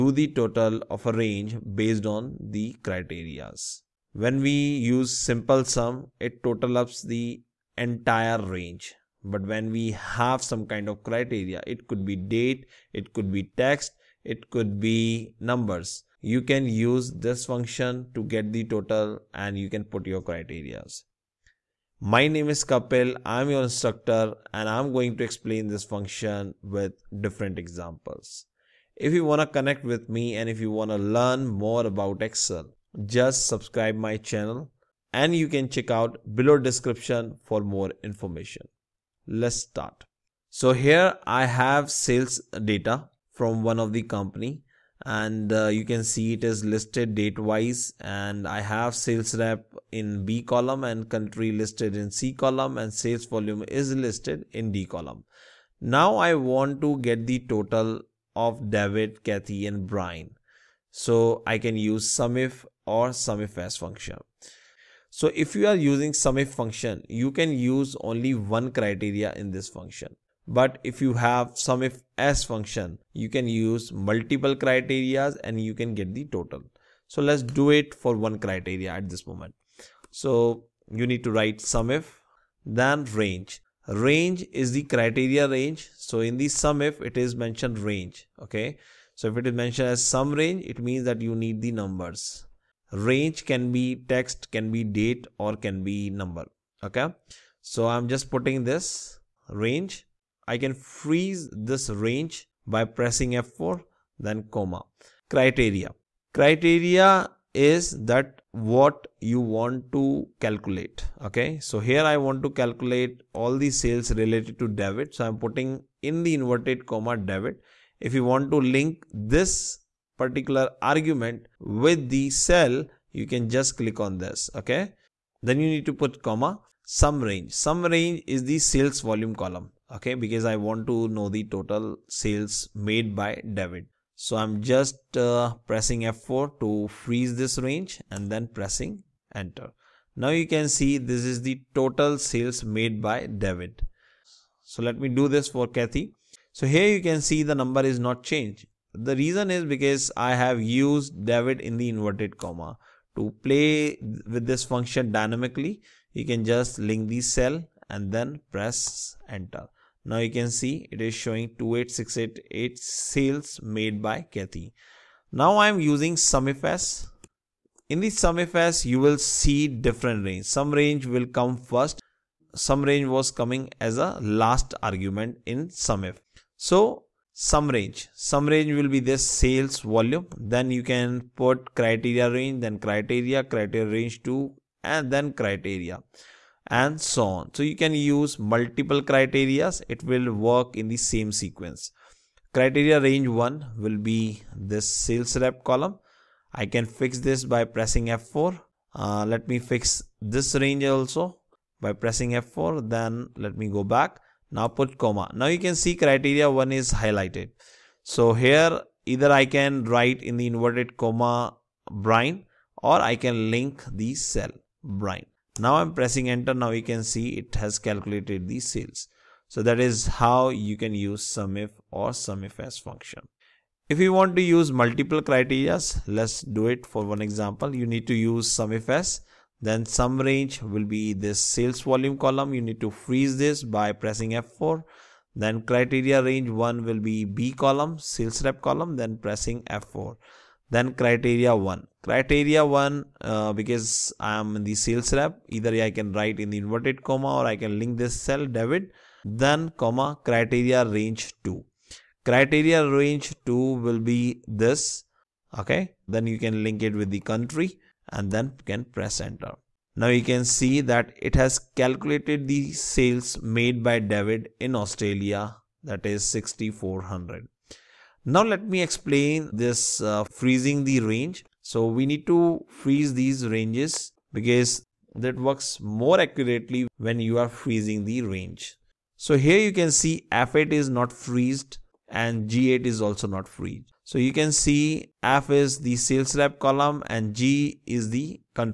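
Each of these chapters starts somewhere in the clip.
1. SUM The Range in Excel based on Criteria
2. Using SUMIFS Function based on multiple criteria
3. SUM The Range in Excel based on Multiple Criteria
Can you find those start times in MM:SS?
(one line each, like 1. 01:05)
1. 01:19
2. 03:43
3. 02:45.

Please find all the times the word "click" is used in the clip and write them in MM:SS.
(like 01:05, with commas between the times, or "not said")
02:03.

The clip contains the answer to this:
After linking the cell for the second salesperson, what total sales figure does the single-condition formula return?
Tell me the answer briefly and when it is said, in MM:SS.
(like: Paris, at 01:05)
28688, at 02:41.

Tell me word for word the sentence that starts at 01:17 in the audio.
So let's do it for one criteria at this moment.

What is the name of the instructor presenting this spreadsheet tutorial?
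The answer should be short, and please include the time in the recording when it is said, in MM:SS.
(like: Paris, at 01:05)
Kapil, at 00:22.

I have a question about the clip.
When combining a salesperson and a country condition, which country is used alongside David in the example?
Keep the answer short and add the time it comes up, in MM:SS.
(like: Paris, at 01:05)
Australia, at 04:24.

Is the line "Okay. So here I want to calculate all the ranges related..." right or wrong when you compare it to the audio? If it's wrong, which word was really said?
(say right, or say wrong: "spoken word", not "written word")
wrong: "sales", not "ranges".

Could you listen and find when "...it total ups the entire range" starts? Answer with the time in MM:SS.
00:06.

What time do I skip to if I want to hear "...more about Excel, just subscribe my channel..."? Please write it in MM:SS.
00:31.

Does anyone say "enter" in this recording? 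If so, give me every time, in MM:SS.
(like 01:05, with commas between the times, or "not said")
02:19, 02:39, 03:36, 04:19.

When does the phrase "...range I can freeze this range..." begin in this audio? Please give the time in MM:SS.
01:39.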